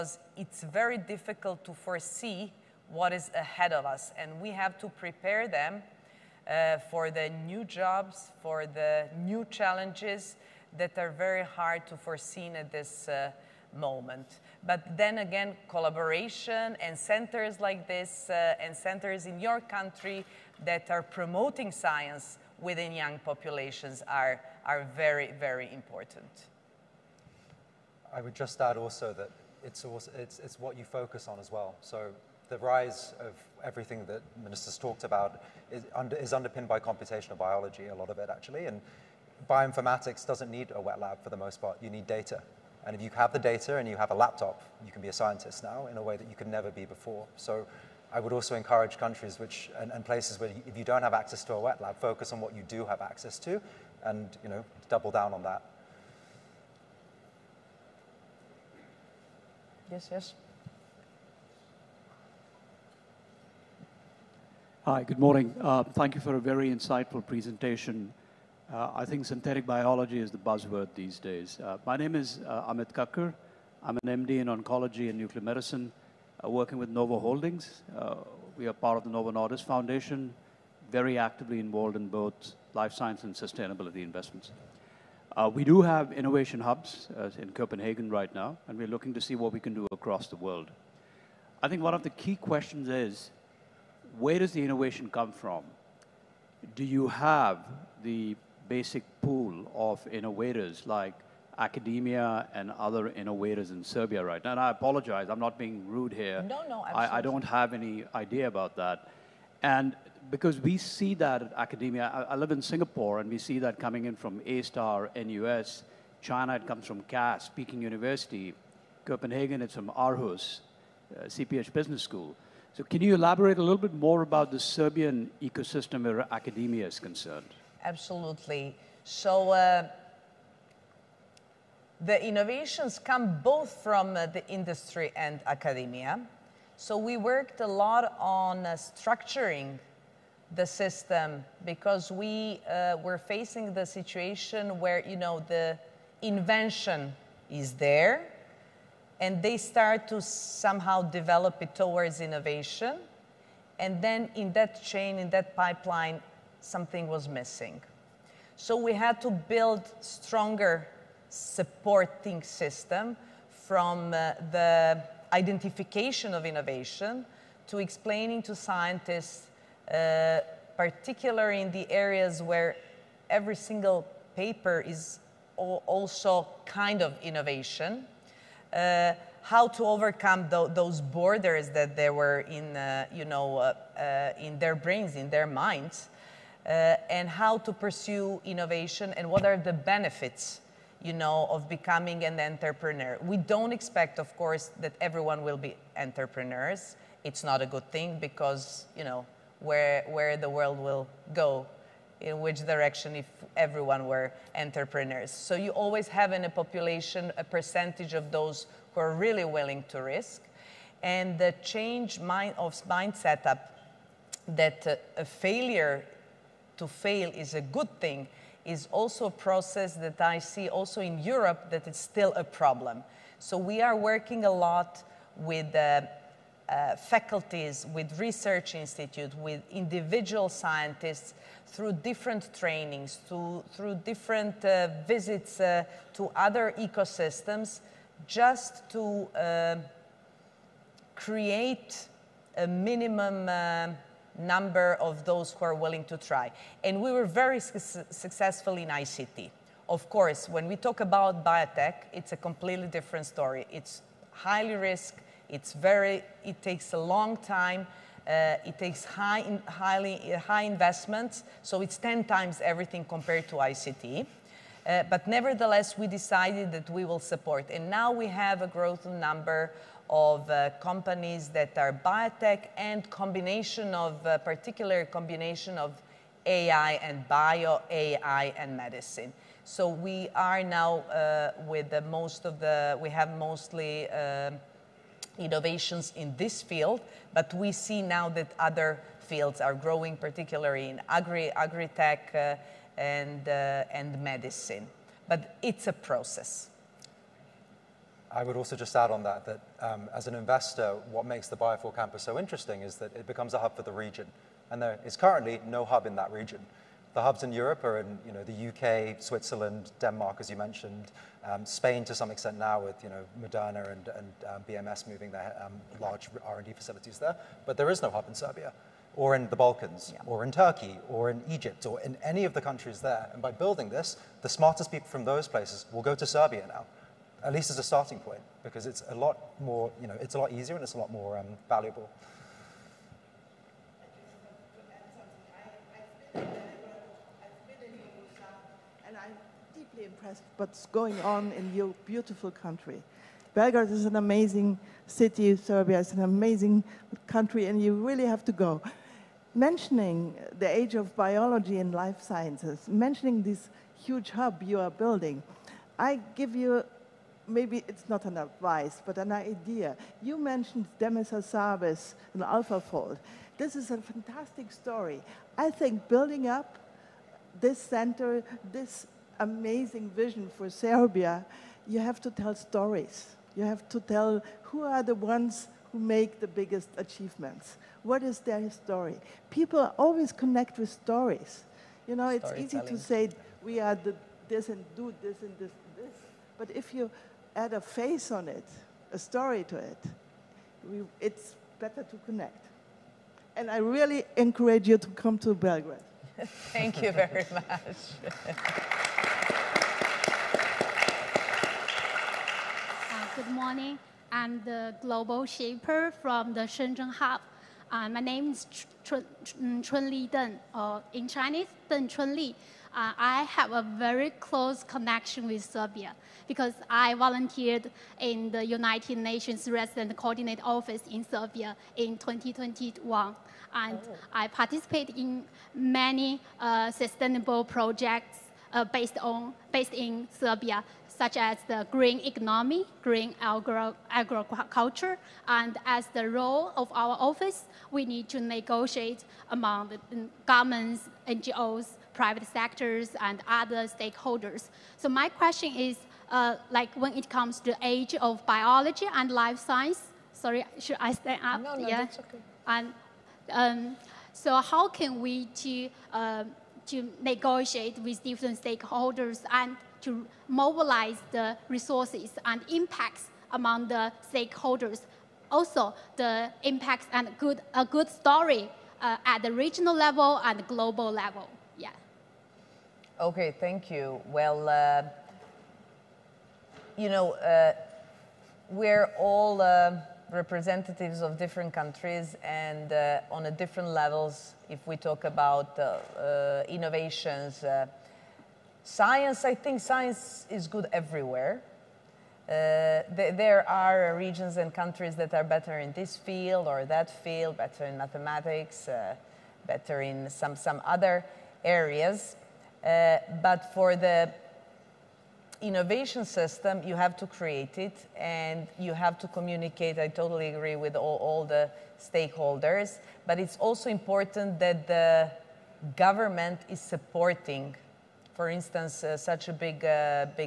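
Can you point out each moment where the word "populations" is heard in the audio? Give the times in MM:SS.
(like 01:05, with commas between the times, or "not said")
00:23, 03:26.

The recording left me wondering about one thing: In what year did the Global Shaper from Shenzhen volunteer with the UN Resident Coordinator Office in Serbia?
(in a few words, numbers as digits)
2021.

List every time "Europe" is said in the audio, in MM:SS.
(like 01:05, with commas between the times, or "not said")
03:41, 05:07.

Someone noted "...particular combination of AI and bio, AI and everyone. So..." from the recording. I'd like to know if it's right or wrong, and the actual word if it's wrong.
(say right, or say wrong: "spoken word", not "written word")
wrong: "medicine", not "everyone".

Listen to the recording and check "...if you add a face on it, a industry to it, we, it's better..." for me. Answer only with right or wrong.
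wrong.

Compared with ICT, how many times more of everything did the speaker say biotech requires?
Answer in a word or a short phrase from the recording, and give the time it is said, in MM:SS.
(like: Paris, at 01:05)
10 times, at 04:21.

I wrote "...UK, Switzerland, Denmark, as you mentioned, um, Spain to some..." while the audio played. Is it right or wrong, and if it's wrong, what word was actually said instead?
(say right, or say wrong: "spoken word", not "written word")
right.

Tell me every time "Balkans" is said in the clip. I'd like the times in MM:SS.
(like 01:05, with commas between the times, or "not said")
05:19.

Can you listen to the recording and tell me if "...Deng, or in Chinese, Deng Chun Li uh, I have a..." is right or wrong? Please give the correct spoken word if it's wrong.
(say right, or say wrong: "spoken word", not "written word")
right.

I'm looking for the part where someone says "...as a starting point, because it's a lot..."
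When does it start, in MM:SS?
05:27.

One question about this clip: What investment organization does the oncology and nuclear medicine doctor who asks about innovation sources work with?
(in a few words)
Novo Holdings.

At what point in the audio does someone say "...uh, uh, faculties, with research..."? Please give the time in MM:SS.
03:45.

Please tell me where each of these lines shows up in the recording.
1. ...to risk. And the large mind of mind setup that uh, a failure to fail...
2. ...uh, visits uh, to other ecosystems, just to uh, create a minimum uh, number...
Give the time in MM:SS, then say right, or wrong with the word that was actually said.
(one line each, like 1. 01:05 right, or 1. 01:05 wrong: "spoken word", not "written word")
1. 03:29 wrong: "change", not "large"
2. 03:54 right.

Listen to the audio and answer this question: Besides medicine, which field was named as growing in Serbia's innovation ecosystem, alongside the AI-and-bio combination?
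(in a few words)
Agri-tech.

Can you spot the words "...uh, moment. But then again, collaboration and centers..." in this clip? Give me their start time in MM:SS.
00:13.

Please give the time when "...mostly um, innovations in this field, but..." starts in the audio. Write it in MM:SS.
04:43.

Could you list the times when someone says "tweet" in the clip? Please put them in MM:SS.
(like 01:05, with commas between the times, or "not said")
not said.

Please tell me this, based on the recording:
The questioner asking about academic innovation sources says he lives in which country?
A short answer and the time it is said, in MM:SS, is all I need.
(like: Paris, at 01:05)
Singapore, at 01:52.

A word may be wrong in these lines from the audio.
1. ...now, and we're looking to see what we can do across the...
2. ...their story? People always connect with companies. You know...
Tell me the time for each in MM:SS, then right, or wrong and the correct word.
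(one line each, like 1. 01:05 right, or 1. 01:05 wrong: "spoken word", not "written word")
1. 01:28 right
2. 06:18 wrong: "stories", not "companies".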